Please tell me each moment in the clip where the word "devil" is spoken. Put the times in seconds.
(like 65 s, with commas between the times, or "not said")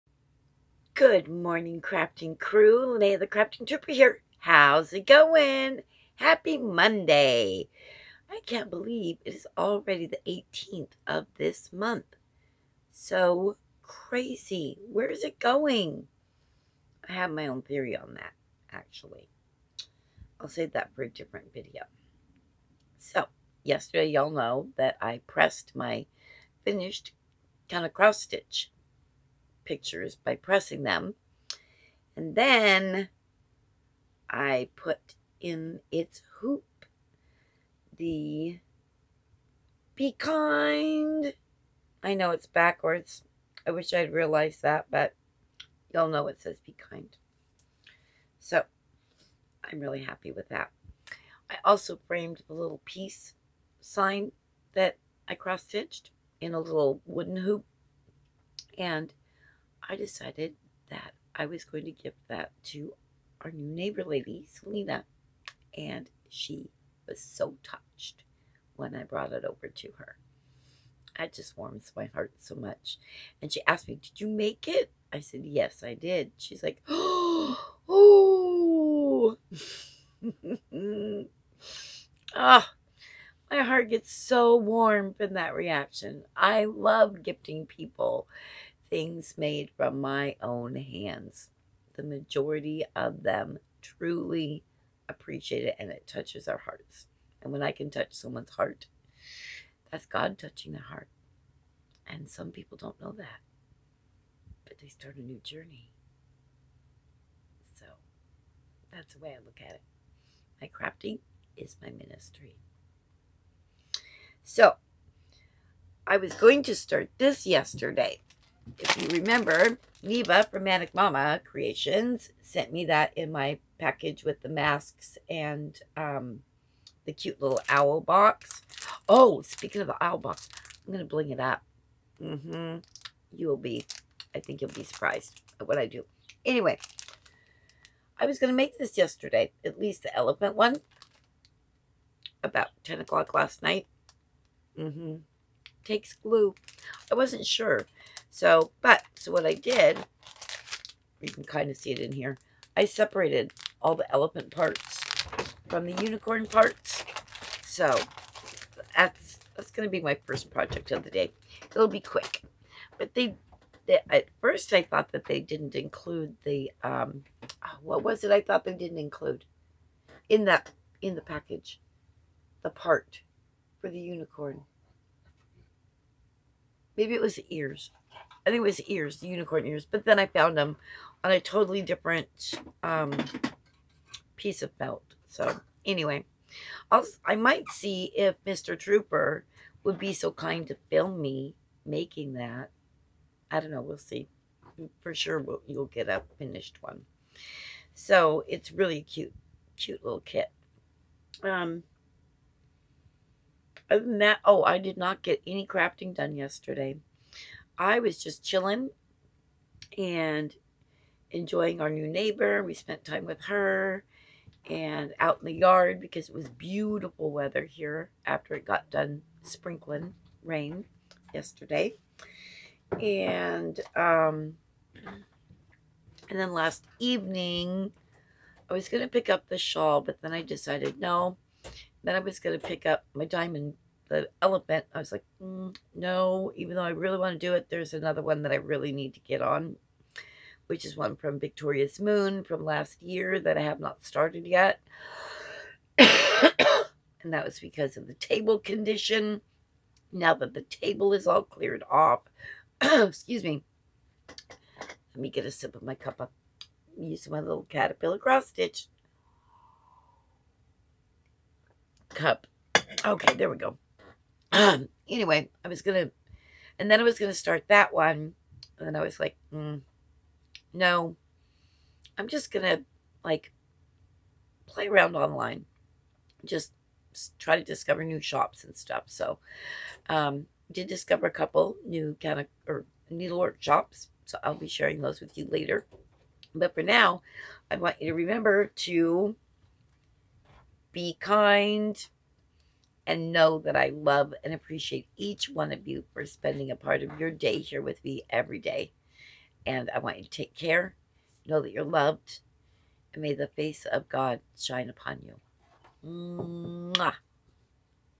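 not said.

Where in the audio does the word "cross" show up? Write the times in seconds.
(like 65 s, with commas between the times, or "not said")
27 s, 55 s, 258 s.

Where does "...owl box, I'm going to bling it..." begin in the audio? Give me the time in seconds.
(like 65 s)
130 s.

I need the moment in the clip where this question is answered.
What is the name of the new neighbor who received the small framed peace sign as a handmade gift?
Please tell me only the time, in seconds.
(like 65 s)
64 s.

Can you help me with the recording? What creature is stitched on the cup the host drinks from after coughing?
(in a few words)
Caterpillar.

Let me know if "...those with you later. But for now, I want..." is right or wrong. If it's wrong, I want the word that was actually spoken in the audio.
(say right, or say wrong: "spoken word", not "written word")
right.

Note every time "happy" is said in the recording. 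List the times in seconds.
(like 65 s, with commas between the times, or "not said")
6 s, 50 s.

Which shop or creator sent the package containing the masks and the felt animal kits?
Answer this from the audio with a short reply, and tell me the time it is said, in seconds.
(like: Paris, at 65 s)
Manic Mama Creations, at 120 s.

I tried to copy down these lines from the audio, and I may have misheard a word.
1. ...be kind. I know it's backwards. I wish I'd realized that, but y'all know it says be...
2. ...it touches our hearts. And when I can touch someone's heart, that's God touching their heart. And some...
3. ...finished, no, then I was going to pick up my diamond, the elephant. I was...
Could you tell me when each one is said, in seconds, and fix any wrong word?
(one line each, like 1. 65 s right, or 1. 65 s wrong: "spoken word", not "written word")
1. 39 s right
2. 95 s right
3. 230 s wrong: "decided", not "finished".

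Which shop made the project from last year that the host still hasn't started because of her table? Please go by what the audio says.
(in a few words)
Victoria's Moon.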